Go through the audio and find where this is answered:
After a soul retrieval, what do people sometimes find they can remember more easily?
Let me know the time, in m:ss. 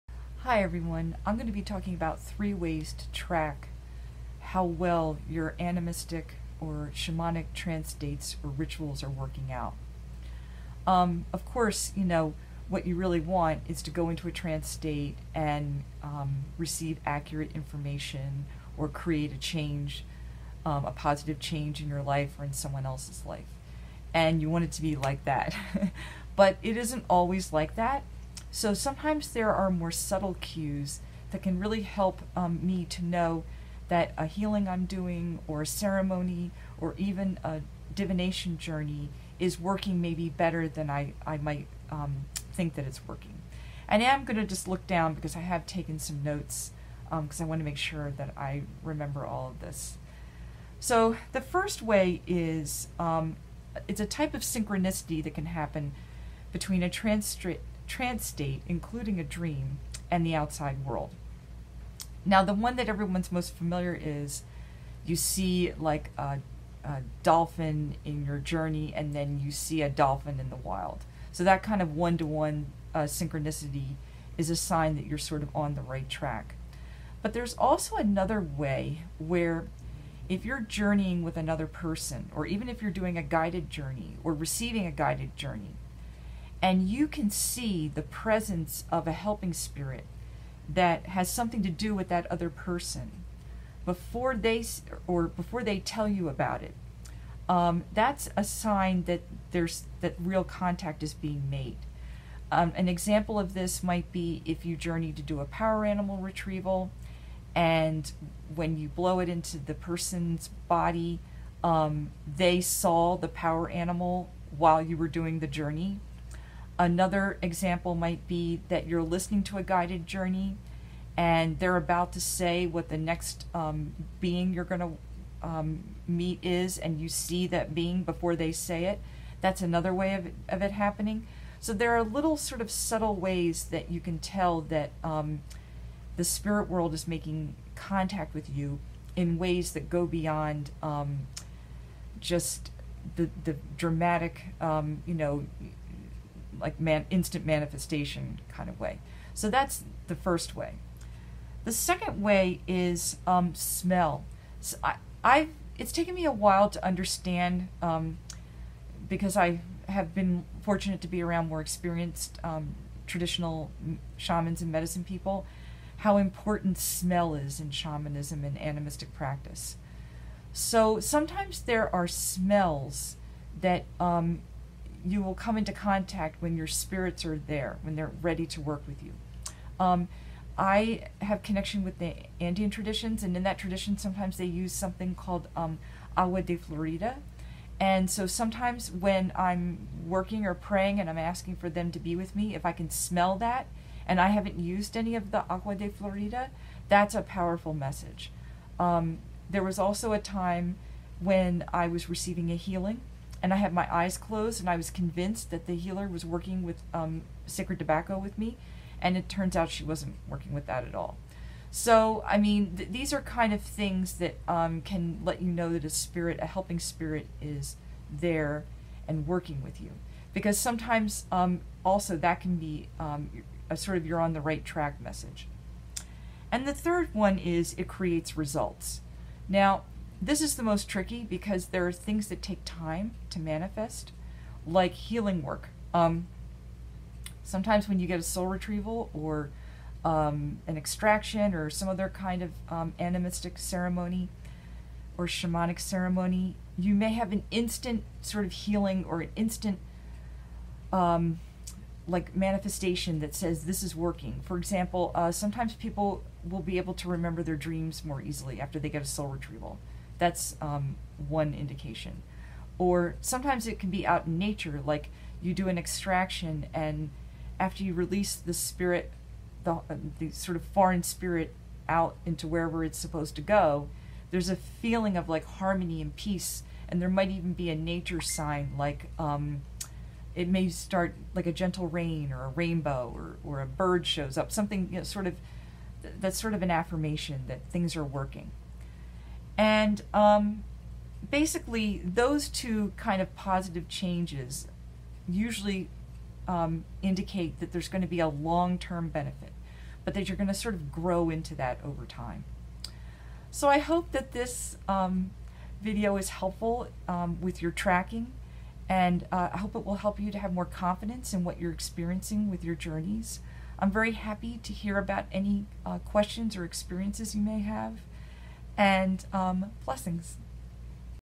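4:17.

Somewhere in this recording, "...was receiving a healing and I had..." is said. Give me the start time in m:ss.
3:21.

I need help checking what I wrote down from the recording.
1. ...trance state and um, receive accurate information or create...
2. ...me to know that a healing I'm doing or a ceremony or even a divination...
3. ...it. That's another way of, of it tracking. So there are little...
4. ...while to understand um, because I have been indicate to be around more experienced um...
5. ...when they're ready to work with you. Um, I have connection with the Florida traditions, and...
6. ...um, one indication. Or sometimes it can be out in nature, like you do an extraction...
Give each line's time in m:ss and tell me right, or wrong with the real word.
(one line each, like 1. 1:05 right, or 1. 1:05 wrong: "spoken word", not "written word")
1. 0:14 right
2. 0:32 right
3. 2:08 wrong: "happening", not "tracking"
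4. 2:36 wrong: "fortunate", not "indicate"
5. 2:57 wrong: "Andean", not "Florida"
6. 4:20 right.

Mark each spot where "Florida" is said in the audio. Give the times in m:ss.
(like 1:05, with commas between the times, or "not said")
3:06, 3:15.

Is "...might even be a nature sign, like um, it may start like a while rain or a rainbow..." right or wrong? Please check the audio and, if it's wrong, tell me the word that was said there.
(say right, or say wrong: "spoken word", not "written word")
wrong: "gentle", not "while".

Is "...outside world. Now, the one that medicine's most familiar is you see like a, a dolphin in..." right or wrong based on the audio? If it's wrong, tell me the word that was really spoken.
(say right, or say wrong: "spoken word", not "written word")
wrong: "everyone", not "medicine".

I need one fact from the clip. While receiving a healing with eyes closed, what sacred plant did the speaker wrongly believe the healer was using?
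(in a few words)
Tobacco.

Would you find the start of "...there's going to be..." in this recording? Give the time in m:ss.
4:57.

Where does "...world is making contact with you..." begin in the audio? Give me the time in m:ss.
2:16.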